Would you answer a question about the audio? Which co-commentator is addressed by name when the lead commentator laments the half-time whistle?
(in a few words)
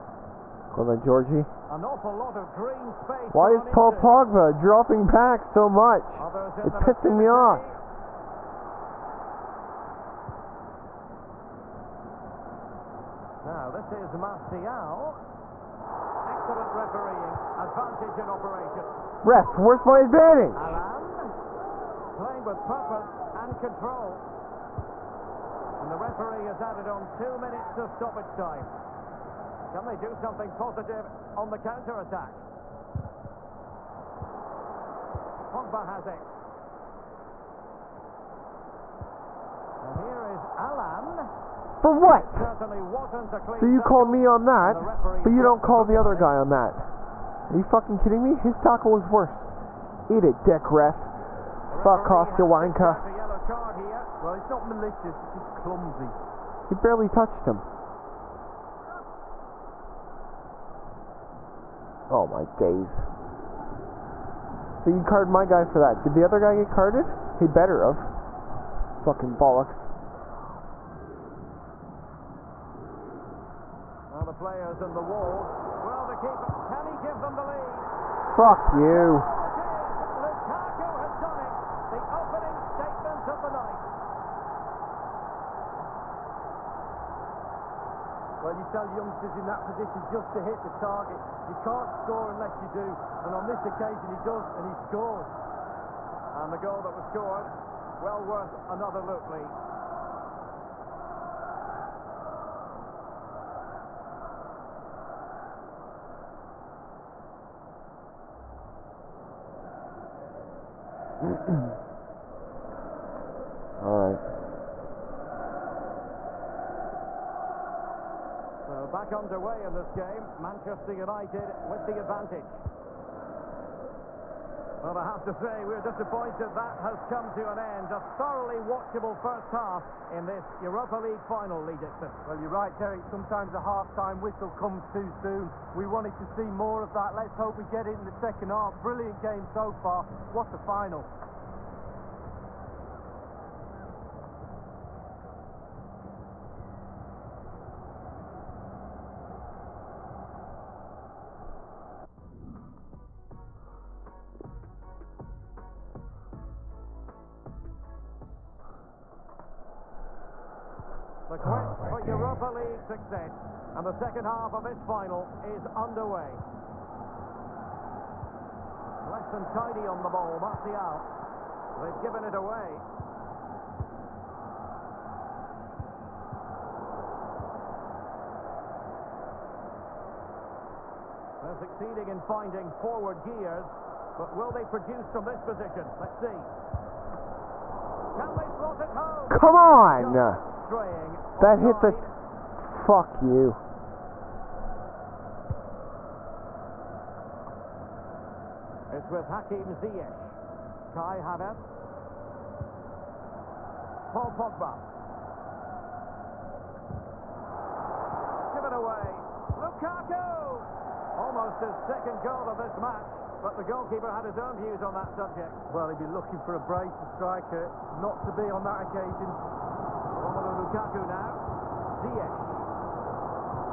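Lee Dixon.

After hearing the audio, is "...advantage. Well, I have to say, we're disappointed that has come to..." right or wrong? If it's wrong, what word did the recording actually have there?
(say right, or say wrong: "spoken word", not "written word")
right.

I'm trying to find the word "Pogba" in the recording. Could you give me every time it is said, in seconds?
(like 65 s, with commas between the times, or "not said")
4 s, 35 s, 204 s.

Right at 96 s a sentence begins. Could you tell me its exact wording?
And the goal that was scored, well worth another look, Lee.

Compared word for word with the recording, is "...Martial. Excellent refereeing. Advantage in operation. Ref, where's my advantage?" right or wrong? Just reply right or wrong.
right.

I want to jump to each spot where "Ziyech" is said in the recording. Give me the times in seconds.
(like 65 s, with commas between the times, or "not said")
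199 s, 221 s.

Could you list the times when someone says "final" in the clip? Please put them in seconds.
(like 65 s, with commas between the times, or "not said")
131 s, 140 s, 164 s.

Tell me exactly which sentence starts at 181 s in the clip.
They're succeeding in finding forward gears, but will they produce from this position?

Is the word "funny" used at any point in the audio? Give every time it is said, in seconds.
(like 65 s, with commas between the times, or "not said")
not said.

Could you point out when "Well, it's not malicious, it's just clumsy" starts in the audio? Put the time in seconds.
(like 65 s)
54 s.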